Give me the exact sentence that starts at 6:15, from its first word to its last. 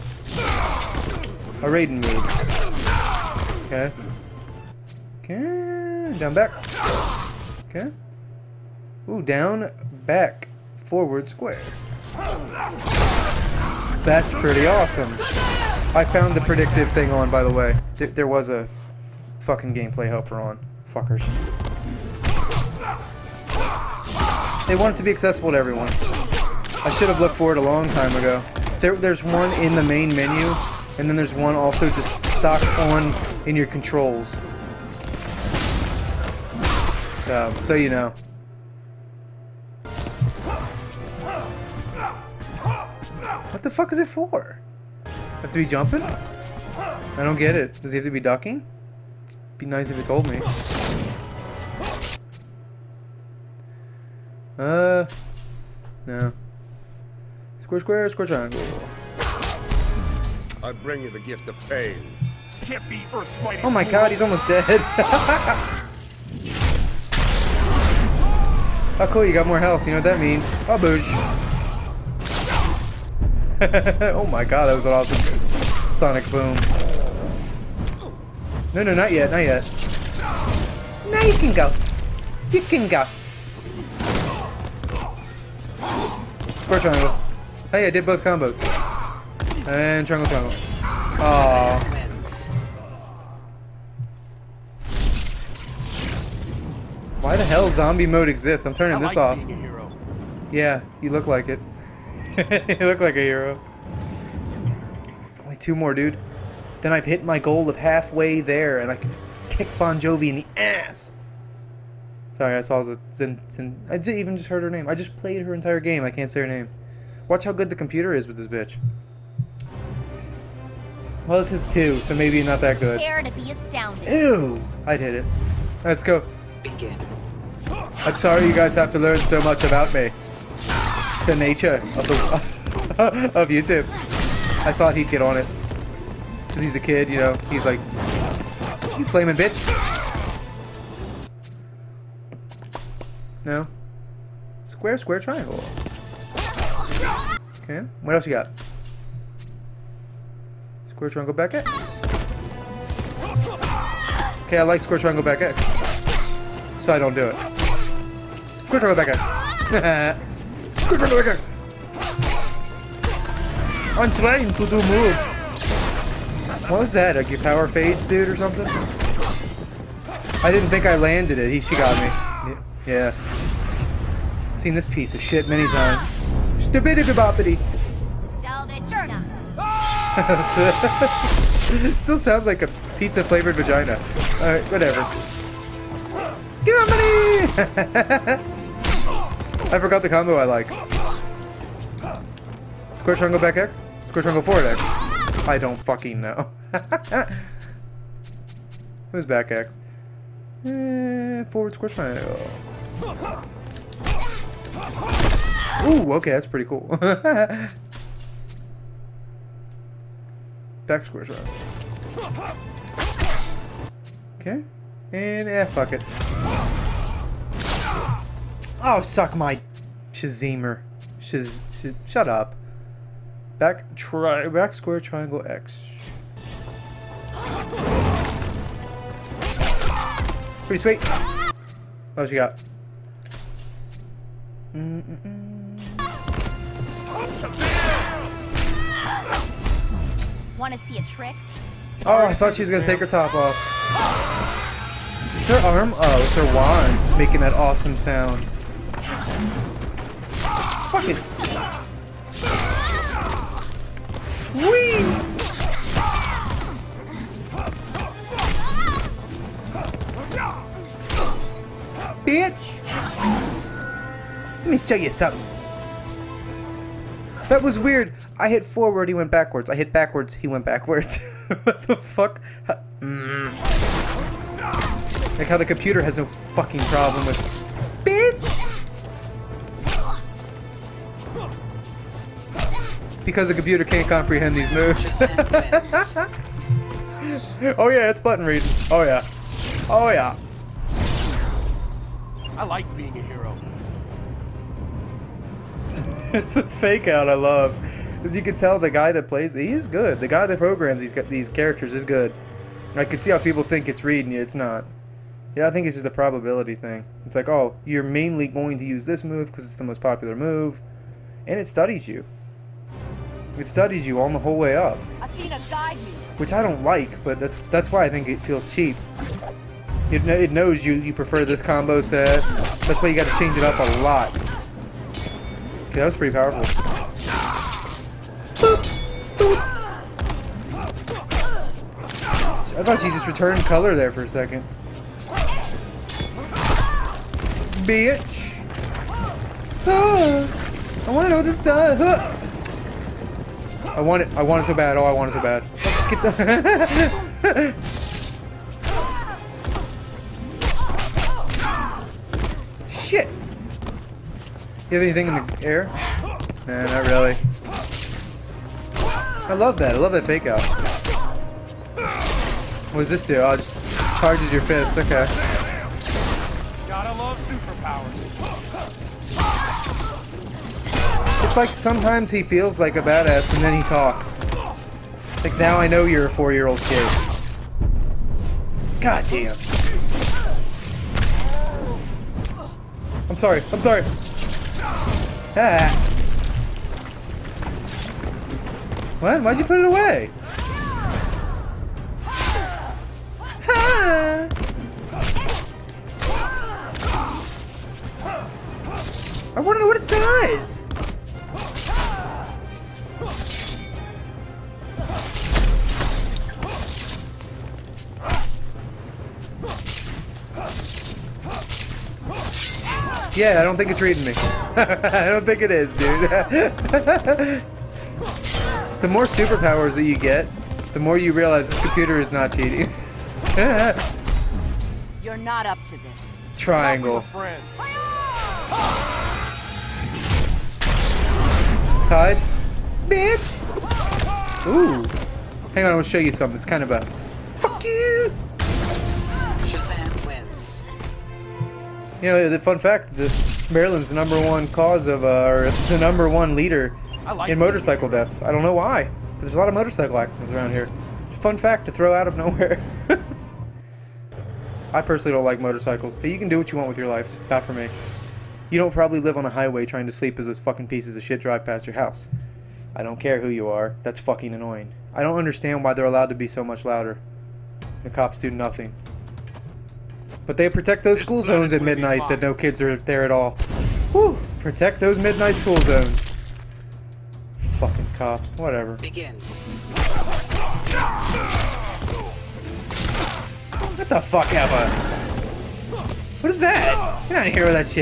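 Like now I know you're a four-year-old kid.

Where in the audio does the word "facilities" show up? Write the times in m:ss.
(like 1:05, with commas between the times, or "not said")
not said.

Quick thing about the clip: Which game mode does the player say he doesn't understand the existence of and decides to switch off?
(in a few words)
zombie mode.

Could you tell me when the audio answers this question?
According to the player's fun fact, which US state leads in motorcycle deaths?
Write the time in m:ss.
7:23.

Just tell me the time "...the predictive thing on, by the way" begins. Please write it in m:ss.
0:16.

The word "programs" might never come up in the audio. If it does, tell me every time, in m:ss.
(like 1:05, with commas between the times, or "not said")
5:00.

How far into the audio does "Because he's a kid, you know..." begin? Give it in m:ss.
2:16.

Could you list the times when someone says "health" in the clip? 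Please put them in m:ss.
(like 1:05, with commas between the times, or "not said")
1:09.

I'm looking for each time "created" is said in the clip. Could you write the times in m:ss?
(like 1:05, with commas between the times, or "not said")
not said.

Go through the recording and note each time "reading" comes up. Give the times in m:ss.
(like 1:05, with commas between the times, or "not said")
4:48, 5:04, 6:53.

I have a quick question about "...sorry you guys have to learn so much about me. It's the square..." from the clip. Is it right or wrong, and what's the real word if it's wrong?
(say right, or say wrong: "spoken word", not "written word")
wrong: "nature", not "square".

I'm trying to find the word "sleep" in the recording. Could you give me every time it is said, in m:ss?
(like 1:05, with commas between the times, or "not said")
7:40.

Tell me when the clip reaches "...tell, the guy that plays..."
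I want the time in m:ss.
4:58.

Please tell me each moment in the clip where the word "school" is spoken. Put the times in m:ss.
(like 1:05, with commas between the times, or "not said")
7:51, 7:55.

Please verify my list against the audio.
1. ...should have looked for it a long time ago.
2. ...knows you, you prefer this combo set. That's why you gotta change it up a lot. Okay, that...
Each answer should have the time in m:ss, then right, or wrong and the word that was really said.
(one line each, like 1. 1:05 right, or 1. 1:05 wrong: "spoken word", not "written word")
1. 0:26 right
2. 5:20 right.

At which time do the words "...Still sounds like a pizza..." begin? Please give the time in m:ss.
3:02.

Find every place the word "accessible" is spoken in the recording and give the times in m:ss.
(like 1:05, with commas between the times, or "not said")
0:25.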